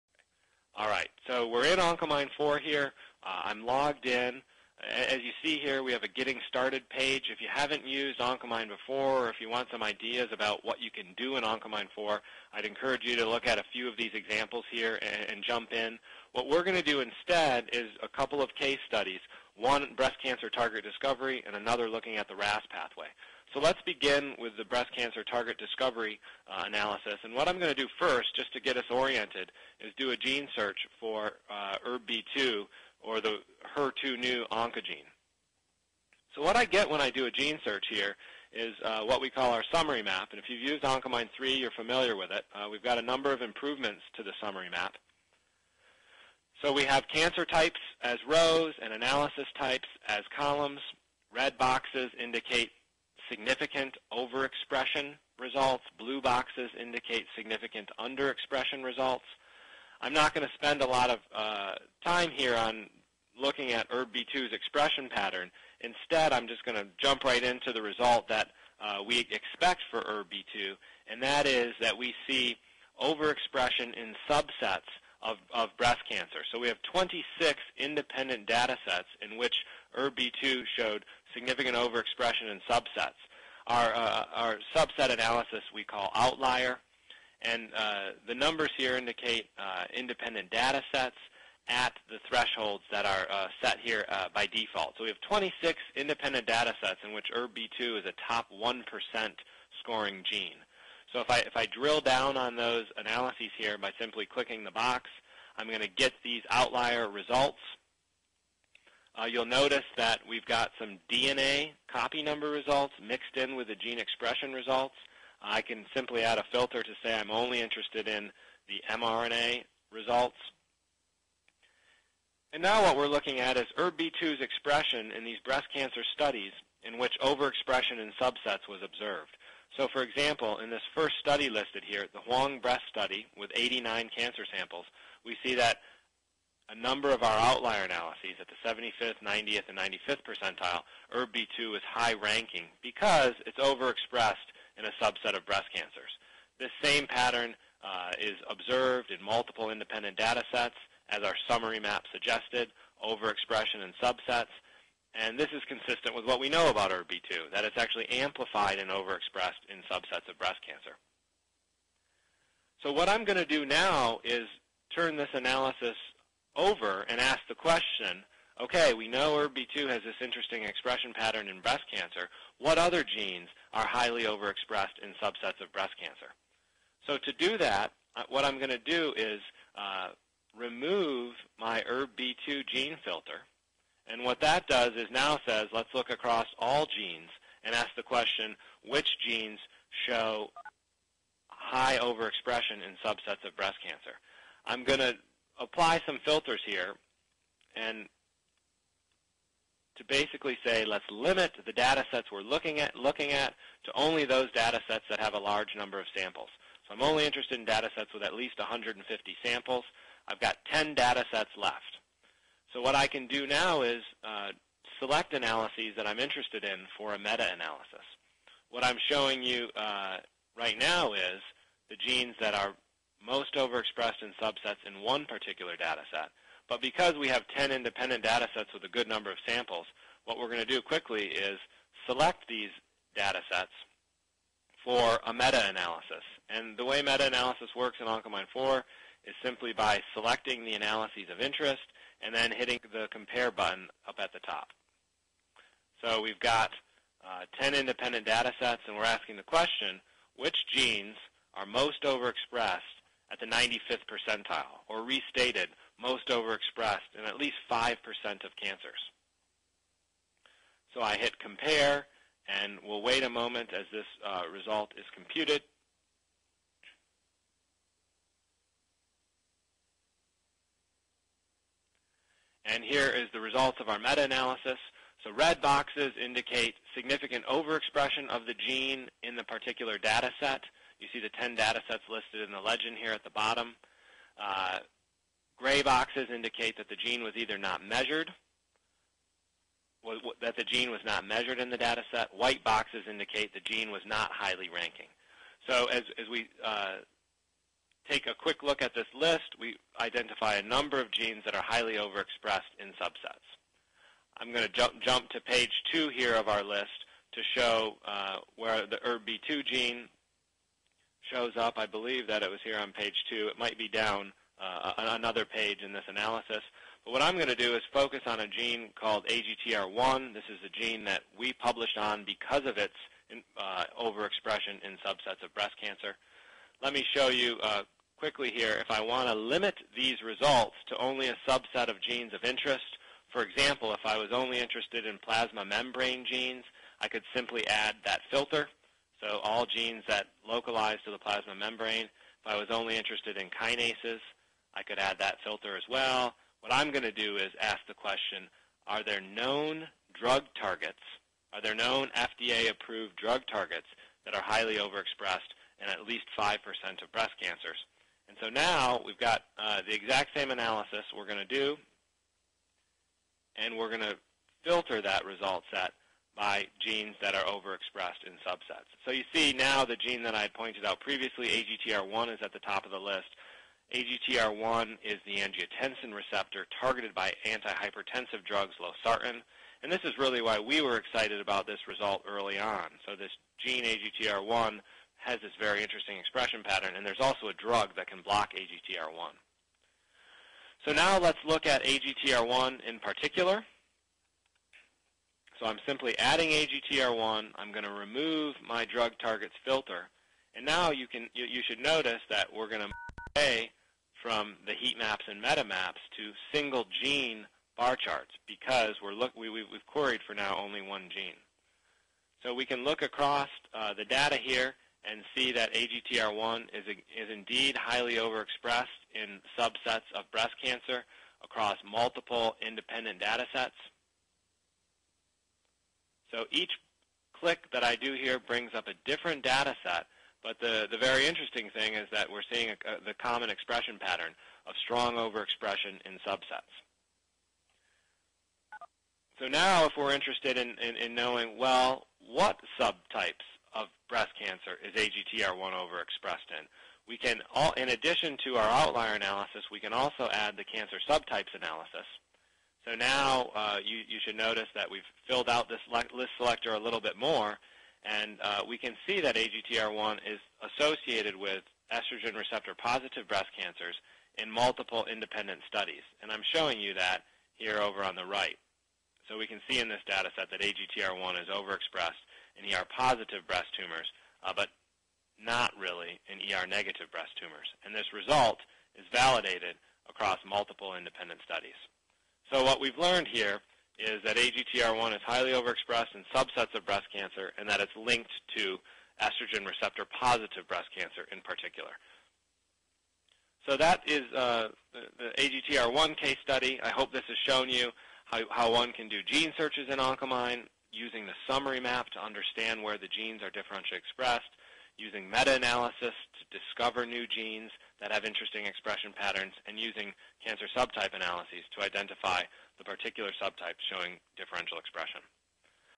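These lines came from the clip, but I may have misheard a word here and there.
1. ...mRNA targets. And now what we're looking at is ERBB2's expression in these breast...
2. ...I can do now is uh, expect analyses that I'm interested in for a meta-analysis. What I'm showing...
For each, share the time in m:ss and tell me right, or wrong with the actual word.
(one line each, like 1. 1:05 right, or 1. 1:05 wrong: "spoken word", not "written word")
1. 1:58 wrong: "results", not "targets"
2. 3:32 wrong: "select", not "expect".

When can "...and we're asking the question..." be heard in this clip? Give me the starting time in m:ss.
4:08.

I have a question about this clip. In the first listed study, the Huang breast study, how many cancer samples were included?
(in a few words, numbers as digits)
89.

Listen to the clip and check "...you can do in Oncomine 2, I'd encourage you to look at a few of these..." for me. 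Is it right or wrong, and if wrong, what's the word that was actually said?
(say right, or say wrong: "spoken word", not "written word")
wrong: "4", not "2".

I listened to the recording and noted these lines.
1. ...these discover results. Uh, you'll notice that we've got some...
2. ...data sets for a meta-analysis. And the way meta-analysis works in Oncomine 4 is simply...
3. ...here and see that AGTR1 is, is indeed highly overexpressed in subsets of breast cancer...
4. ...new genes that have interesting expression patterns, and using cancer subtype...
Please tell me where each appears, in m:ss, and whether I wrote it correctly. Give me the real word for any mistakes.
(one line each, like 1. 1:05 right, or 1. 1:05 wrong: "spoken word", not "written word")
1. 1:46 wrong: "outlier", not "discover"
2. 3:53 right
3. 6:54 right
4. 8:27 right.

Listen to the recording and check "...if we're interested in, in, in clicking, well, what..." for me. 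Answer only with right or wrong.
wrong.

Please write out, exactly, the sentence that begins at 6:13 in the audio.
AGTR1 is the angiotensin receptor targeted by antihypertensive drugs, losartan.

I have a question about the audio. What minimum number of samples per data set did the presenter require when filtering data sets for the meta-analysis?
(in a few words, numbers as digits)
150.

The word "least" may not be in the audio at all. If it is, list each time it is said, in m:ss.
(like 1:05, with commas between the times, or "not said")
3:28, 4:17, 5:56.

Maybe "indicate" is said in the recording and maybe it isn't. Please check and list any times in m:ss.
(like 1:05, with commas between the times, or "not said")
0:52, 0:56, 1:28, 4:36, 4:46, 4:53.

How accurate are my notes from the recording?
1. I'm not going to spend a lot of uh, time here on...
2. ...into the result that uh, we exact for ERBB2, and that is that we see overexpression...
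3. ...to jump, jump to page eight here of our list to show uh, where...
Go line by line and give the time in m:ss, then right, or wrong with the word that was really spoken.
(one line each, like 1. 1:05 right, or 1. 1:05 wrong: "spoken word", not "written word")
1. 1:00 right
2. 1:07 wrong: "expect", not "exact"
3. 5:04 wrong: "two", not "eight".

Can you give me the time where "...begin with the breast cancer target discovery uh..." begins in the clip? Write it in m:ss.
0:23.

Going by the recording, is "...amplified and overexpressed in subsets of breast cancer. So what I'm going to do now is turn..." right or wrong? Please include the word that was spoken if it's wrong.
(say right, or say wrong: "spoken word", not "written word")
right.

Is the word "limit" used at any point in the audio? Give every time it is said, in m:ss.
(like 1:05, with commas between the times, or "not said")
3:21, 5:29.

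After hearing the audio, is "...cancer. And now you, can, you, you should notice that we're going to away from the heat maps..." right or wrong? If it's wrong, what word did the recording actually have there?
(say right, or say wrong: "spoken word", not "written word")
wrong: "filter", not "cancer".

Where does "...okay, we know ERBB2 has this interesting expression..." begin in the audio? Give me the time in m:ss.
2:48.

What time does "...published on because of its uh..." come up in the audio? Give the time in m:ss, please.
5:21.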